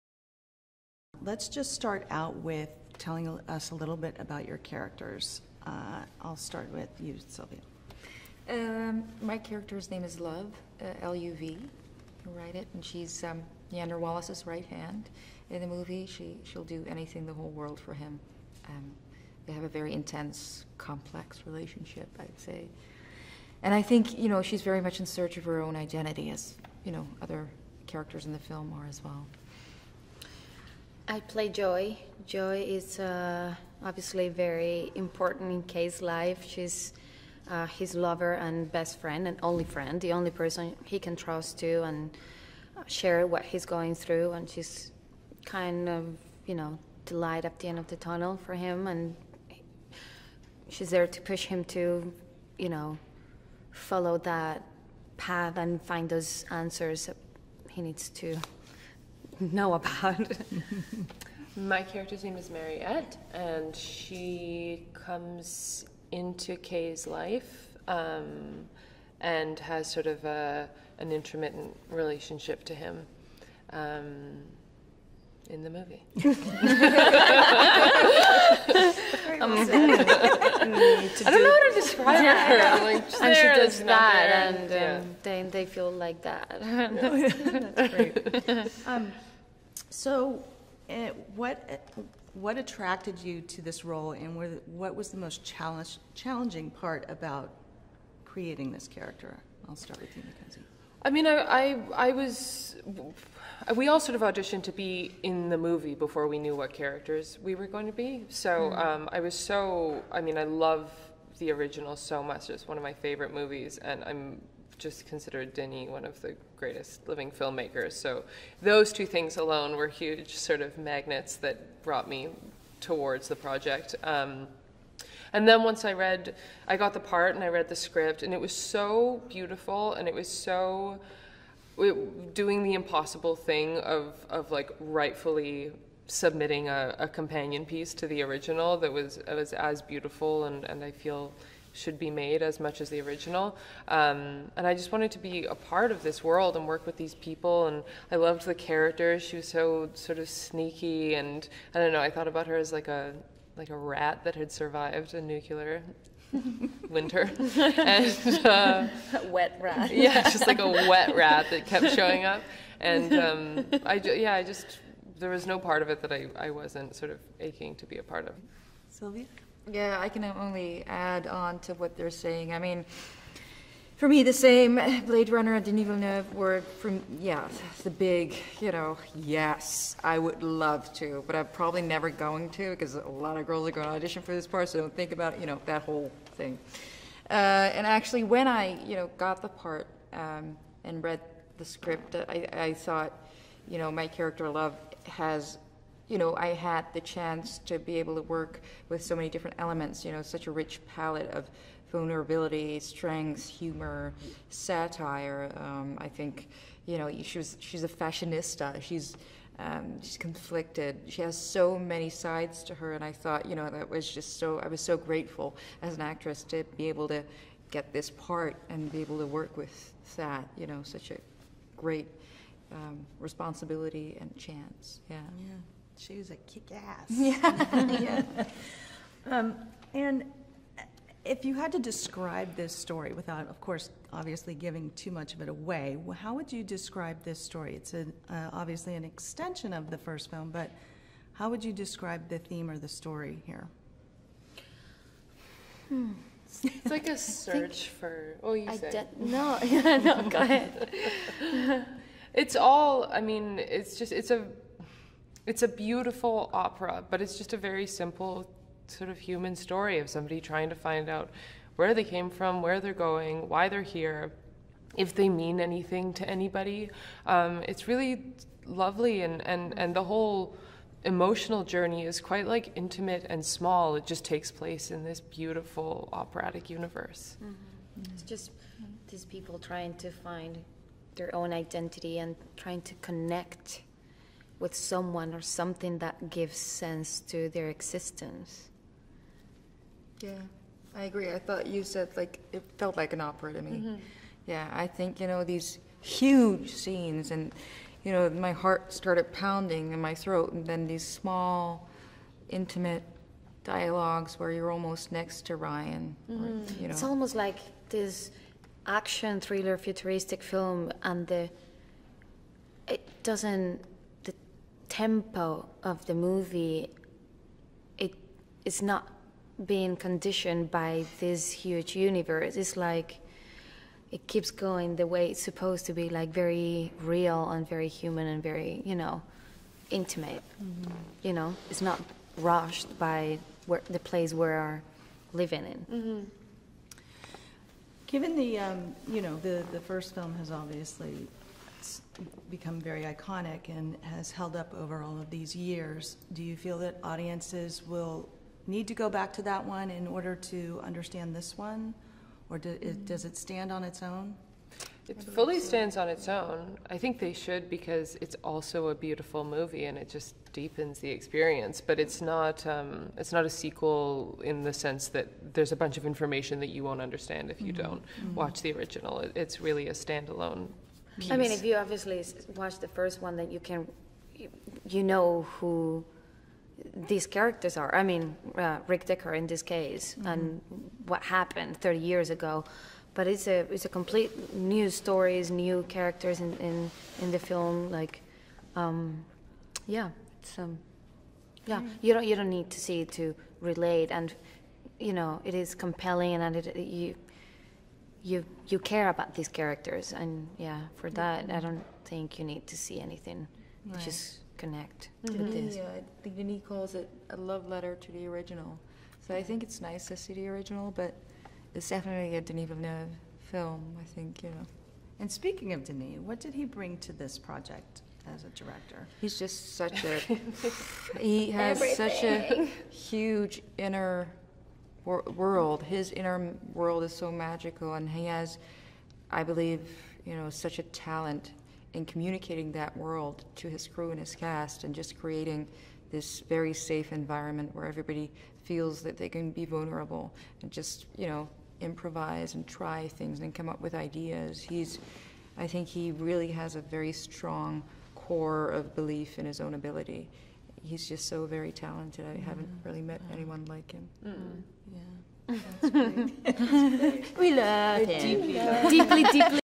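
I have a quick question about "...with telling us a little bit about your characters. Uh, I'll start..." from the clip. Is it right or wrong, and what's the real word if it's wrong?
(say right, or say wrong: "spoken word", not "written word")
right.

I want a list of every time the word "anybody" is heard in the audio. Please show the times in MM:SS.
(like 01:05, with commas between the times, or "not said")
04:26.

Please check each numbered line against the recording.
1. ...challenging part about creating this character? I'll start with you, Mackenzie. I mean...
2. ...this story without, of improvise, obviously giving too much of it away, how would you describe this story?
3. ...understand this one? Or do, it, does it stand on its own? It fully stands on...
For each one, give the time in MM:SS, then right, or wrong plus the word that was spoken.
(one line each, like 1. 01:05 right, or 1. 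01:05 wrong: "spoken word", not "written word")
1. 01:36 right
2. 03:52 wrong: "course", not "improvise"
3. 05:50 right.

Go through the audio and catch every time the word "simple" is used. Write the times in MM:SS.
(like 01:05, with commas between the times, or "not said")
04:17.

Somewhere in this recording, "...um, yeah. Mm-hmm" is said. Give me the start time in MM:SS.
06:30.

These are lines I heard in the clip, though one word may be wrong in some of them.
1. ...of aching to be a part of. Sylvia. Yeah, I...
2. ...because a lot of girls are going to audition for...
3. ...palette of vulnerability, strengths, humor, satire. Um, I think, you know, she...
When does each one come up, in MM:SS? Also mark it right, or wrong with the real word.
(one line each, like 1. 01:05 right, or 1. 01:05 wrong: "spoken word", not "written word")
1. 02:47 right
2. 03:02 right
3. 03:20 right.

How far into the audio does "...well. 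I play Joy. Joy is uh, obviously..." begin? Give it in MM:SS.
00:29.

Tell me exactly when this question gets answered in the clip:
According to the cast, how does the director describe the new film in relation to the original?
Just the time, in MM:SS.
06:47.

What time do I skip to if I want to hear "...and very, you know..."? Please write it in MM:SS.
05:28.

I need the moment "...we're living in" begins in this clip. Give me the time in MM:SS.
05:34.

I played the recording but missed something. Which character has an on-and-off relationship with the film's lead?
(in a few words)
Mariette.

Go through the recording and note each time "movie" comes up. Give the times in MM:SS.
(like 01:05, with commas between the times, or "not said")
00:15, 01:15, 01:45, 01:53, 05:16, 05:59.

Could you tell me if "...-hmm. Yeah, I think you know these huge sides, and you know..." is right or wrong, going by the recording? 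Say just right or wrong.
wrong.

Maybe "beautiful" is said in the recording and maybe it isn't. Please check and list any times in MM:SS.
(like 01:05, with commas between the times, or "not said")
02:09, 02:19, 04:15, 04:35, 05:58.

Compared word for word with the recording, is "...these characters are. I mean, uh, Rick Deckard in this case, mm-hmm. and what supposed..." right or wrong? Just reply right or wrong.
wrong.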